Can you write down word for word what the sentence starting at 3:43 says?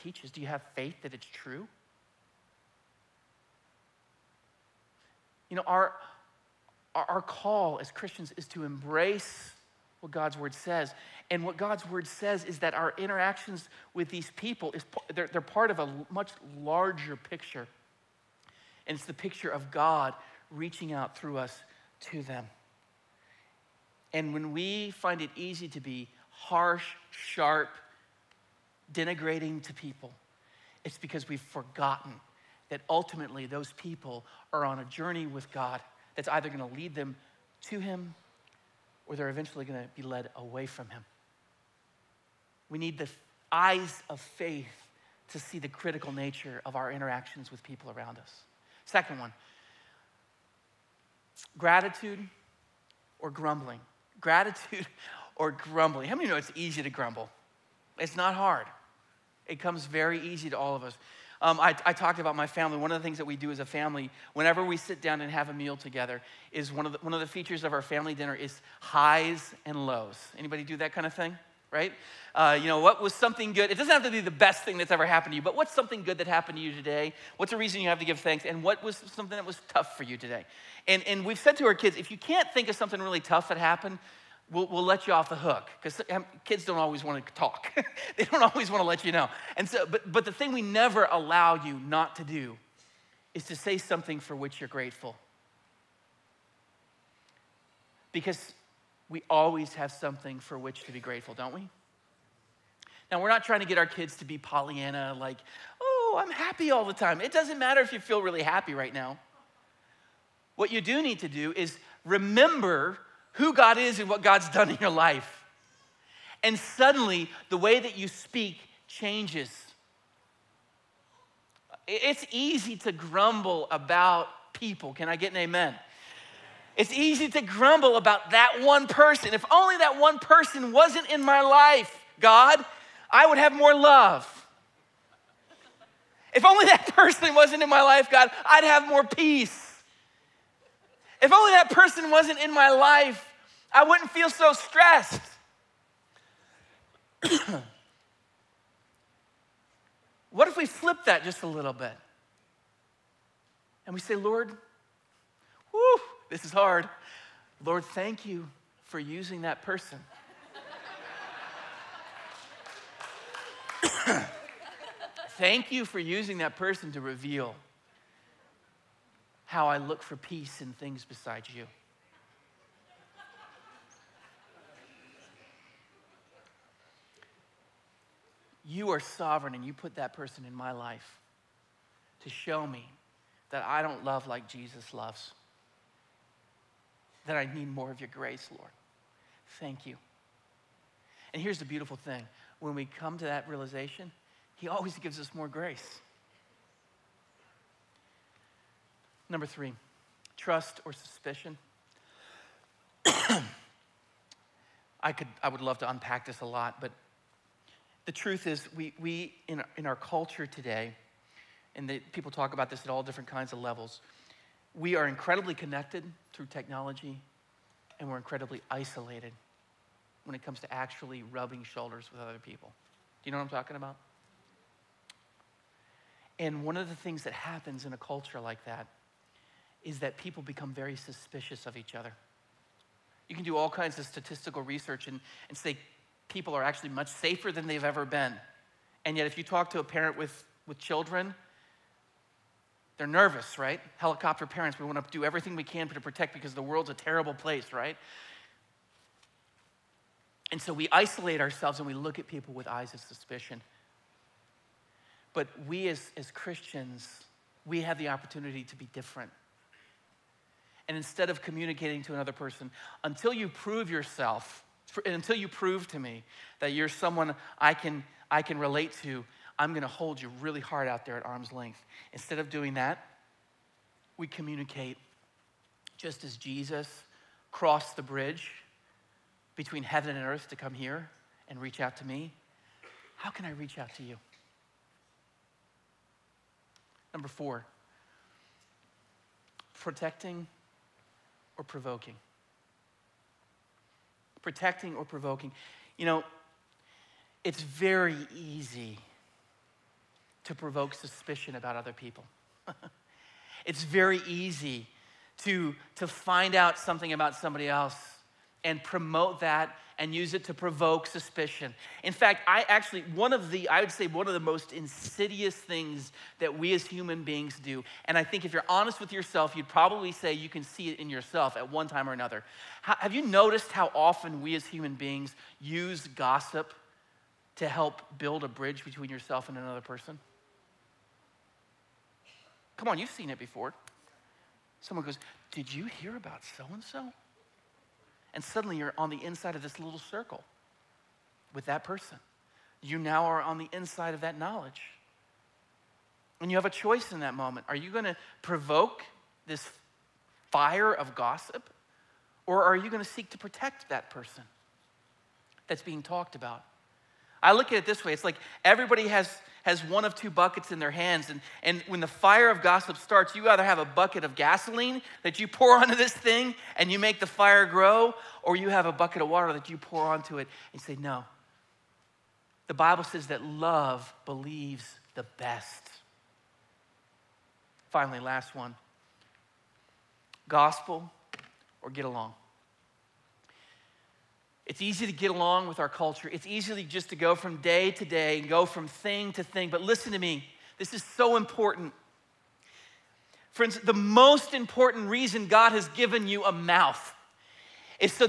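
Do you know what I'm talking about?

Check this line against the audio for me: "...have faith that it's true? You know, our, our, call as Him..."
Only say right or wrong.
wrong.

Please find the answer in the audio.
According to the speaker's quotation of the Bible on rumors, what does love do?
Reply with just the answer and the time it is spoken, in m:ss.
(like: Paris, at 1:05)
Believes the best, at 6:14.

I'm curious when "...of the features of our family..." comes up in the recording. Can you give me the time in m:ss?
1:07.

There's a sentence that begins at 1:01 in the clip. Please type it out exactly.
Um, I, I, talked about my family.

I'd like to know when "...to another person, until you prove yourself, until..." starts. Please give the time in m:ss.
4:22.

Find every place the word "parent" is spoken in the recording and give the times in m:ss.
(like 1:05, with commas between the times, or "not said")
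3:59, 4:04.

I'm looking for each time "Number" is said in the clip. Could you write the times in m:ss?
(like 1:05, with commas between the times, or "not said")
3:19, 4:47.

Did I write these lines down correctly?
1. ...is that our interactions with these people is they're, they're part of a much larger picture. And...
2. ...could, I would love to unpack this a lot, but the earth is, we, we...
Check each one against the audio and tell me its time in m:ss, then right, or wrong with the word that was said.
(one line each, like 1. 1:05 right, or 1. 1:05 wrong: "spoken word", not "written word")
1. 0:12 right
2. 3:25 wrong: "truth", not "earth".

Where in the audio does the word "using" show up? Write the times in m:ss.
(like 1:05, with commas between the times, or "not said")
2:38, 2:45.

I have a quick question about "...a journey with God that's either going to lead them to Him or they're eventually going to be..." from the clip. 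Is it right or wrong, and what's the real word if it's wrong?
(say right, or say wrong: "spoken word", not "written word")
right.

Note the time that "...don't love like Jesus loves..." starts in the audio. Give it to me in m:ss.
3:03.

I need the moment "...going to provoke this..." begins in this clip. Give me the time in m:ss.
5:47.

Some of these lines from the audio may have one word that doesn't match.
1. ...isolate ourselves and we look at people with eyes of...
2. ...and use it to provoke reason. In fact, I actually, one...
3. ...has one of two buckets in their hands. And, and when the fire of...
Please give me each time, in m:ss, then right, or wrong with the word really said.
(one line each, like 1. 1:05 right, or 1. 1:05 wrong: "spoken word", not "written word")
1. 4:10 right
2. 5:09 wrong: "suspicion", not "reason"
3. 5:59 right.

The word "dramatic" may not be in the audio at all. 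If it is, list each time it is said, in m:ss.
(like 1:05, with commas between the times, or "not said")
not said.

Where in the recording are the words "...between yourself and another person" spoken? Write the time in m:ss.
5:28.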